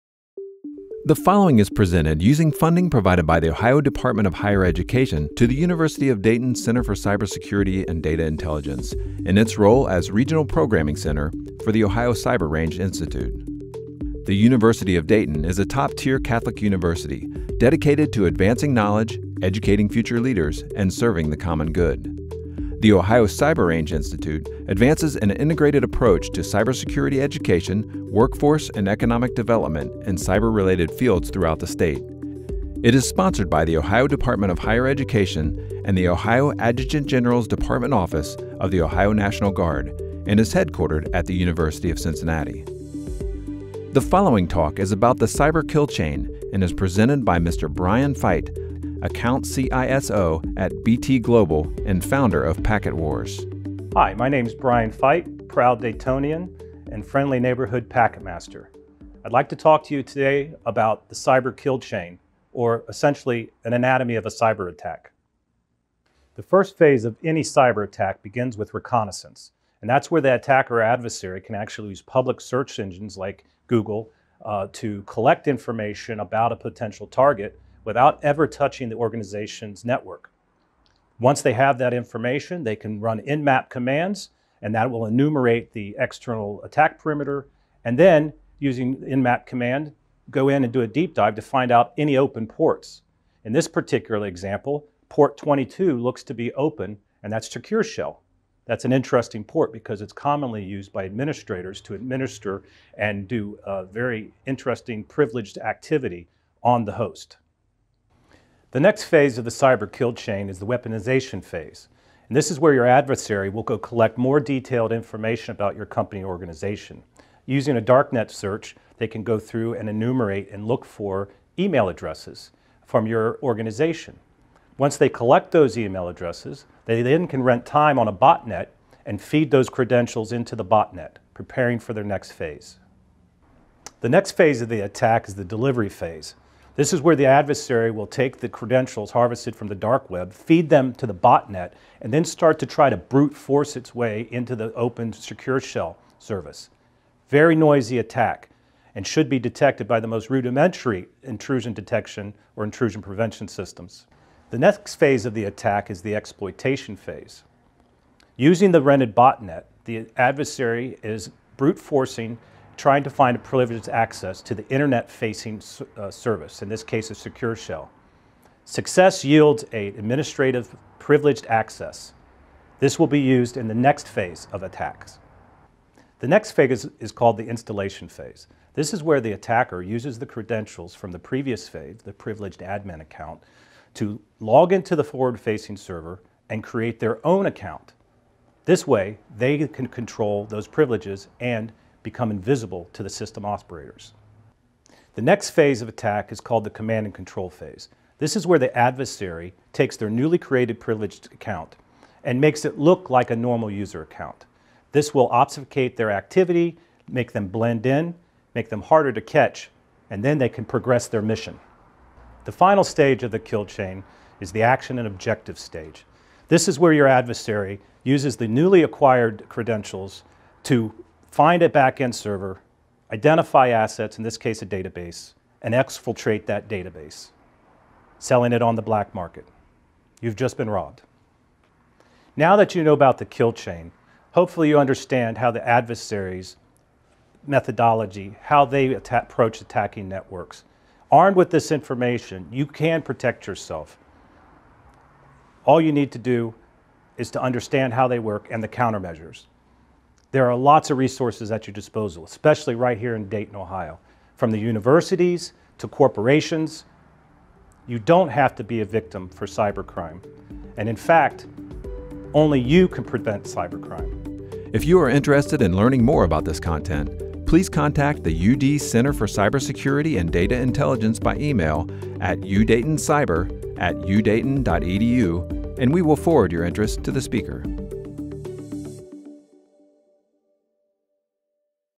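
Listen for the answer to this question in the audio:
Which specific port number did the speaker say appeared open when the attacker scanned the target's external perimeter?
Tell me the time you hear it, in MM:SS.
01:35.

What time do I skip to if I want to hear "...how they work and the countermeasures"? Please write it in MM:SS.
04:07.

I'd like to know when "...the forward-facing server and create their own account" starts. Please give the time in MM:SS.
03:04.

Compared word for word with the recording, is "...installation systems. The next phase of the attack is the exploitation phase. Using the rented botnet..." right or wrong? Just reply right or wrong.
wrong.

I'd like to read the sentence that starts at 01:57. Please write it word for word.
Using a darknet search, they can go through and enumerate and look for email addresses from your organization.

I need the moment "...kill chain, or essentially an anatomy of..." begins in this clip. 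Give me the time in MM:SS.
01:01.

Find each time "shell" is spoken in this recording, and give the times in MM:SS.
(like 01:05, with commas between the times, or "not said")
01:37, 02:25, 02:47.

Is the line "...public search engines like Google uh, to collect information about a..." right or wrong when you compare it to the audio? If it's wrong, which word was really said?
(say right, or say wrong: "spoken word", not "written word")
right.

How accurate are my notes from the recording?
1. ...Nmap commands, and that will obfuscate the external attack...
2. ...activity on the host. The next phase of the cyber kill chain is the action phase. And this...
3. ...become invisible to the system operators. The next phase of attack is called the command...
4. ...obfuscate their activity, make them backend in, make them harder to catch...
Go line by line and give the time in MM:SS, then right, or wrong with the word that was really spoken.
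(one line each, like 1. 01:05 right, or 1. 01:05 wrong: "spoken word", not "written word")
1. 01:23 wrong: "enumerate", not "obfuscate"
2. 01:45 wrong: "weaponization", not "action"
3. 03:12 right
4. 03:25 wrong: "blend", not "backend".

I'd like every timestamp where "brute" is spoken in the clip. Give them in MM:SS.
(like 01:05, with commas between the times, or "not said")
02:22, 02:41.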